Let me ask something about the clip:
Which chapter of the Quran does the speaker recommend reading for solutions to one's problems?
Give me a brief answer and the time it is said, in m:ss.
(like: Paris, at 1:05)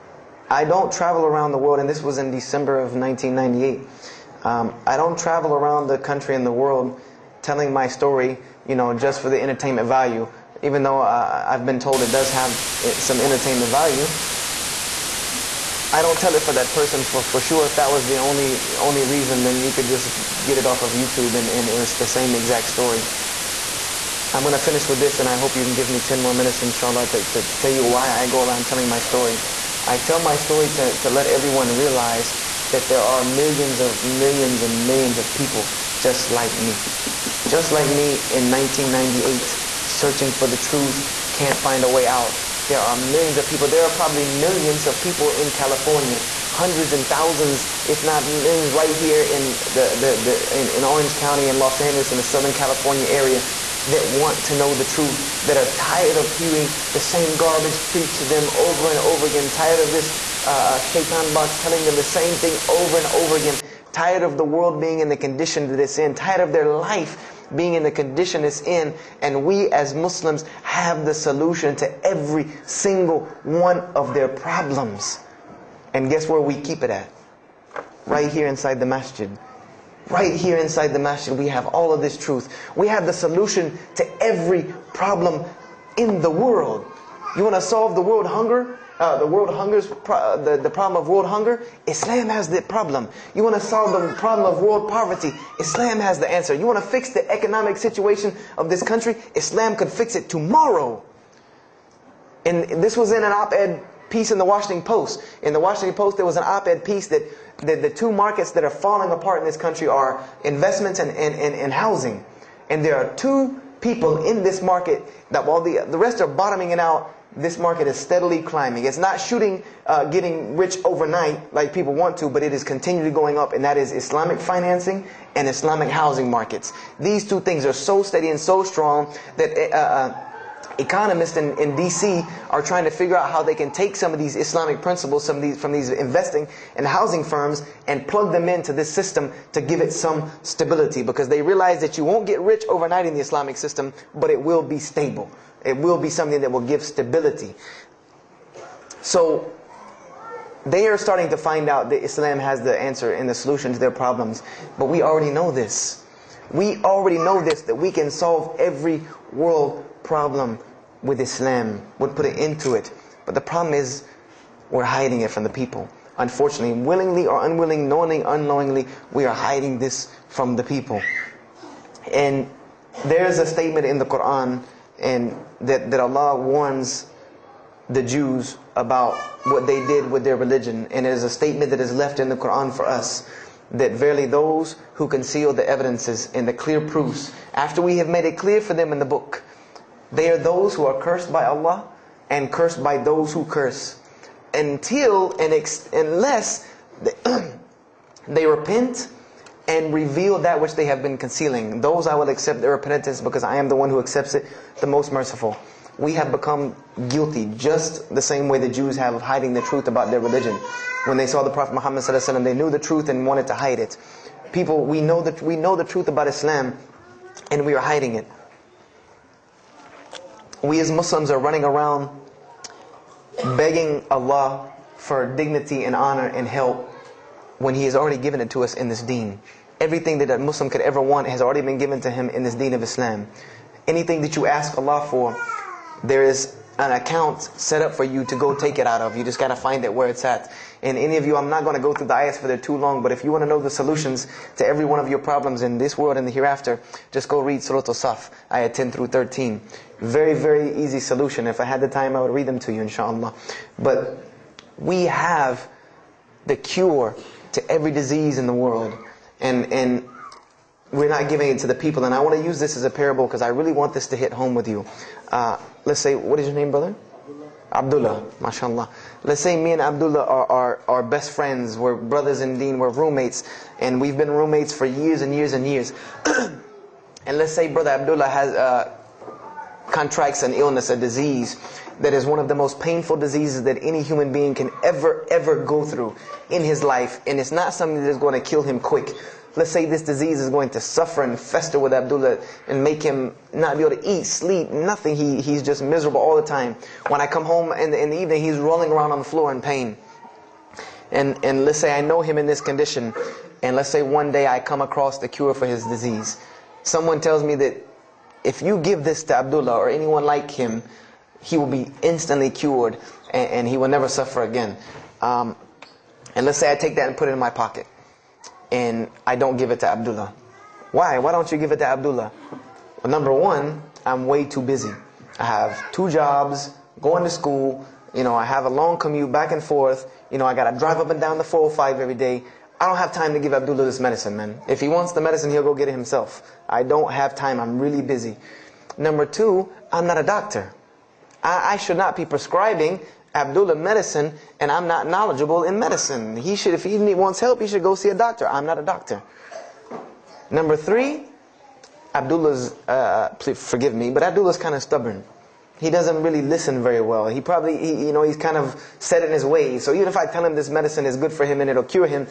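Surah Al-Saf, at 4:07.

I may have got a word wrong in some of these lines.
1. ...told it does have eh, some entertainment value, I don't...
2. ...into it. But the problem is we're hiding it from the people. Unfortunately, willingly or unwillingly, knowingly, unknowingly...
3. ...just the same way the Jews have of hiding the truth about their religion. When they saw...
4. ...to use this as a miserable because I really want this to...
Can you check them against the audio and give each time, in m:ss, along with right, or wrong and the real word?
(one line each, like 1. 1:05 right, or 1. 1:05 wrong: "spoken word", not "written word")
1. 0:11 right
2. 2:42 right
3. 3:27 right
4. 4:22 wrong: "parable", not "miserable".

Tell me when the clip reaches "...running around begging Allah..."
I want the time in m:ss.
3:41.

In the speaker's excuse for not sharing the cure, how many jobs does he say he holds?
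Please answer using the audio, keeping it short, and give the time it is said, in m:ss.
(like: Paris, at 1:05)
2, at 5:25.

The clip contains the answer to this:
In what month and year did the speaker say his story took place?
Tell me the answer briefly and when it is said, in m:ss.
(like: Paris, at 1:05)
December 1998, at 0:02.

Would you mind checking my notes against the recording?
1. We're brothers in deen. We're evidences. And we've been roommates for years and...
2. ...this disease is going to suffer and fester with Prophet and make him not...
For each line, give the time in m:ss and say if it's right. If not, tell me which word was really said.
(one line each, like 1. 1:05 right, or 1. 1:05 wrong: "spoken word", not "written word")
1. 4:31 wrong: "roommates", not "evidences"
2. 4:49 wrong: "Abdullah", not "Prophet".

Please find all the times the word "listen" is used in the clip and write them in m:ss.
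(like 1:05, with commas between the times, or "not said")
5:56.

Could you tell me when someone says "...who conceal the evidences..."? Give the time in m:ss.
3:04.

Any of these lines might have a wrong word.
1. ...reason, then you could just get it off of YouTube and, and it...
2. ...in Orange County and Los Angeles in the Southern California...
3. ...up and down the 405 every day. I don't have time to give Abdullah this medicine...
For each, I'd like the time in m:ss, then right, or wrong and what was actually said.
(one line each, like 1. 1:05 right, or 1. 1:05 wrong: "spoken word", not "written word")
1. 0:19 right
2. 0:50 right
3. 5:30 right.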